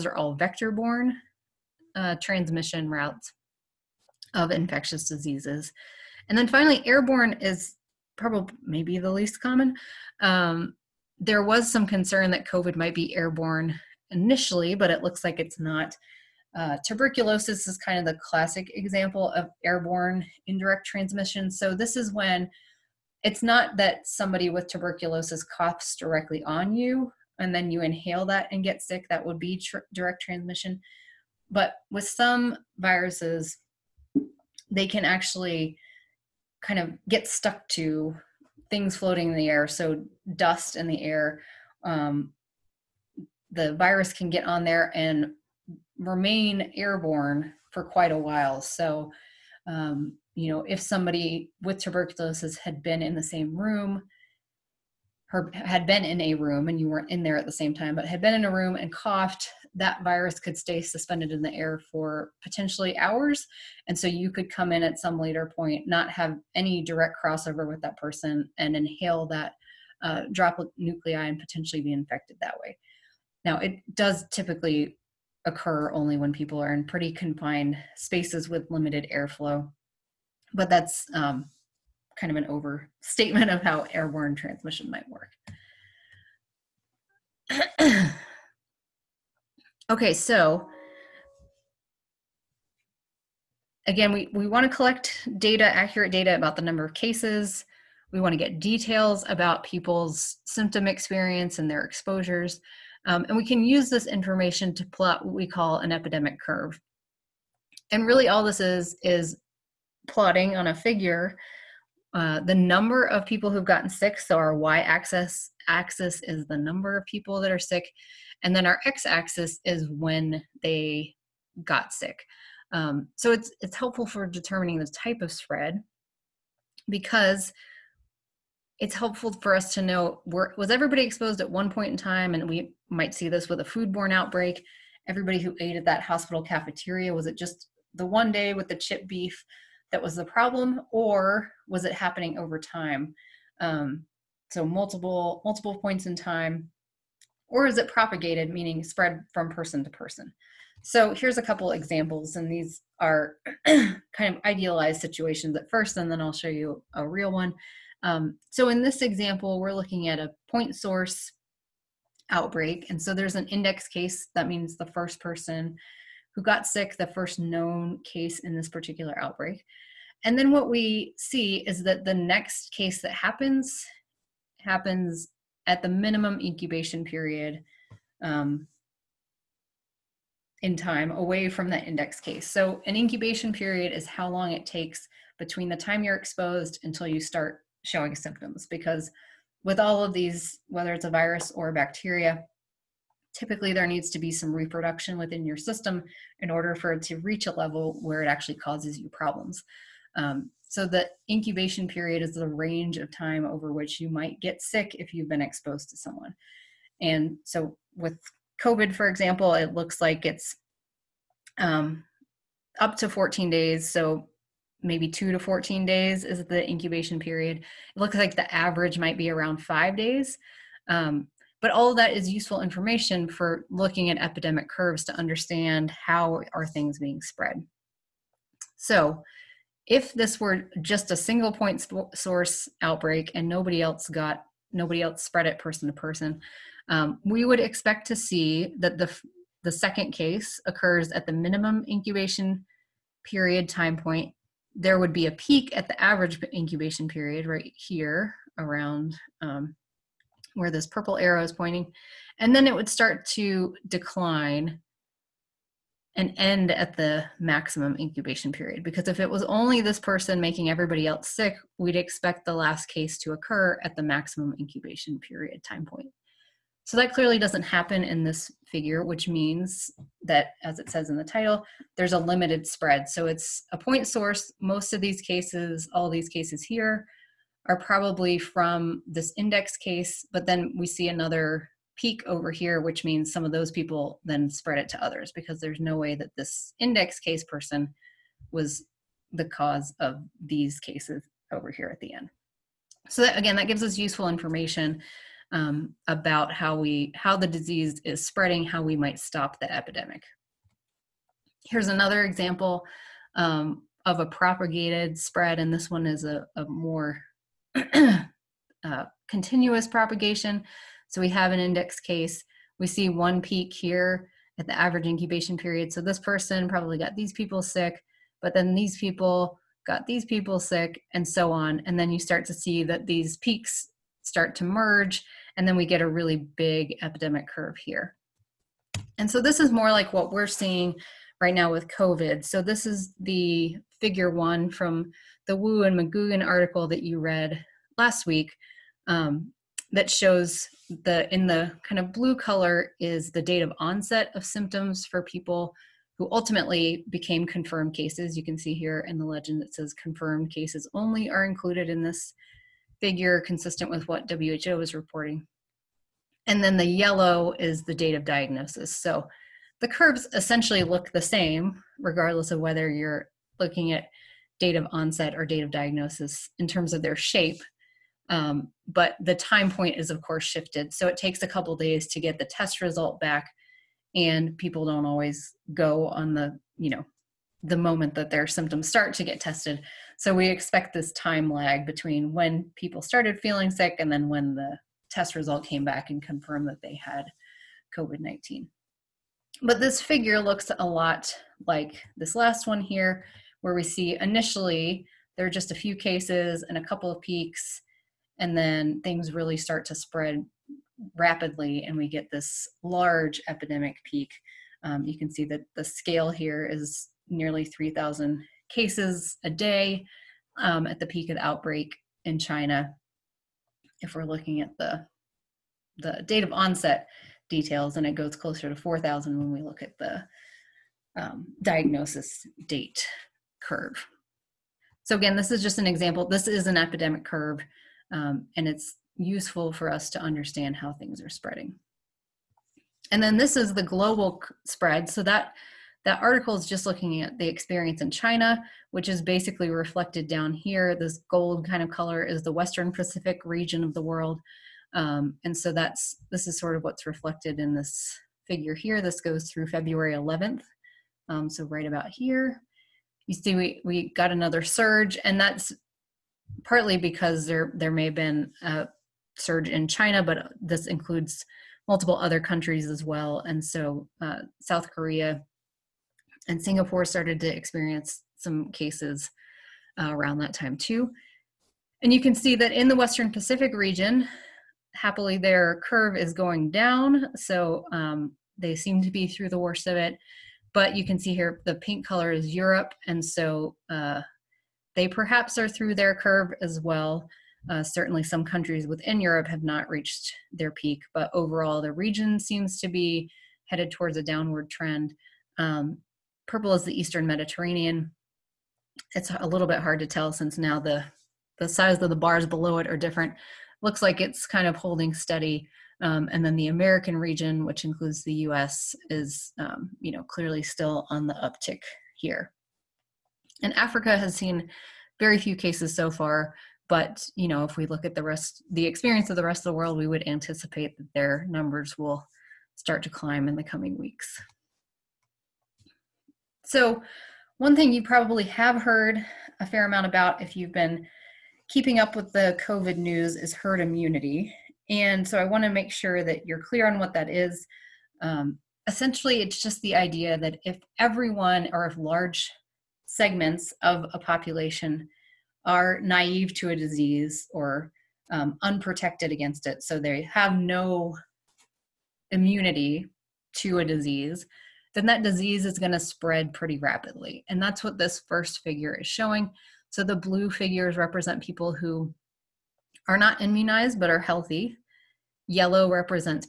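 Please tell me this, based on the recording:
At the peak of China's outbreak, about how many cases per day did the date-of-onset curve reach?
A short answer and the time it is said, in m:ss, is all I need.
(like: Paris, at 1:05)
Nearly 3,000, at 6:47.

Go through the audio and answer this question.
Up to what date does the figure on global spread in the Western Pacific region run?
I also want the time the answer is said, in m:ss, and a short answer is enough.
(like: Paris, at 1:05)
February 11th, at 7:29.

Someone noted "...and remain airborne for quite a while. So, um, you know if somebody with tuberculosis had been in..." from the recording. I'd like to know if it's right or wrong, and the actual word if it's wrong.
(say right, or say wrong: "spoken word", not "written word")
right.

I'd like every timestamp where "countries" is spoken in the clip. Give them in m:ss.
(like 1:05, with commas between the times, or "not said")
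7:42, 8:08.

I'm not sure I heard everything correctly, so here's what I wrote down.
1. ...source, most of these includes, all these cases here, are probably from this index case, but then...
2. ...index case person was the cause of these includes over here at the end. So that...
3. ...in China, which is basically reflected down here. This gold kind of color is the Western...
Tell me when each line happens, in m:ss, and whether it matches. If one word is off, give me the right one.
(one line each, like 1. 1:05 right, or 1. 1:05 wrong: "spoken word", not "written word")
1. 4:34 wrong: "cases", not "includes"
2. 4:46 wrong: "cases", not "includes"
3. 7:18 right.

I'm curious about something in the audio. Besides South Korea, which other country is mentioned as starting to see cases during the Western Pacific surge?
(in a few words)
Singapore.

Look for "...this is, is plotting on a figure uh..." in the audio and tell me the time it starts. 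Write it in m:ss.
1:48.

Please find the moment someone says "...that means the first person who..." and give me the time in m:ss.
2:44.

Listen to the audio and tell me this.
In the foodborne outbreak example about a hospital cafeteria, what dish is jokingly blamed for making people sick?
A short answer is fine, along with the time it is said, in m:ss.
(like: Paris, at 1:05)
Chip beef, at 2:18.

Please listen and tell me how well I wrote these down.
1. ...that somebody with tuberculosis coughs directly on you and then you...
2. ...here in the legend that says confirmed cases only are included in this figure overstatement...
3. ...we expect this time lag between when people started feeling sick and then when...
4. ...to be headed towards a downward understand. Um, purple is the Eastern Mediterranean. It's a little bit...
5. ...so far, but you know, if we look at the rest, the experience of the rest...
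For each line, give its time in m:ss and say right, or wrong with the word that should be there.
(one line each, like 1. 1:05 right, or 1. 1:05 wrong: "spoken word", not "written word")
1. 0:23 right
2. 5:48 wrong: "consistent", not "overstatement"
3. 6:20 right
4. 8:12 wrong: "trend", not "understand"
5. 8:35 right.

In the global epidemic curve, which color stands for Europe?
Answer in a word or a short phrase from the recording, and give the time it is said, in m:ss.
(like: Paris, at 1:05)
Pink, at 8:01.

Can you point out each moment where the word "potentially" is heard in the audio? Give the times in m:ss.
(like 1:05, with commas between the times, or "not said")
1:02, 1:11.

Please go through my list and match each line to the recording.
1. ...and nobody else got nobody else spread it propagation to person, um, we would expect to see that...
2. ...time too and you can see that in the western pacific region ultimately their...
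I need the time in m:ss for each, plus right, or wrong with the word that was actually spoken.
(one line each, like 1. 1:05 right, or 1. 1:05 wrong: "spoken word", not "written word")
1. 3:53 wrong: "person", not "propagation"
2. 7:50 wrong: "happily", not "ultimately".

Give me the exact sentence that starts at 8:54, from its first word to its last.
And so I want to make sure that you're clear on what that is.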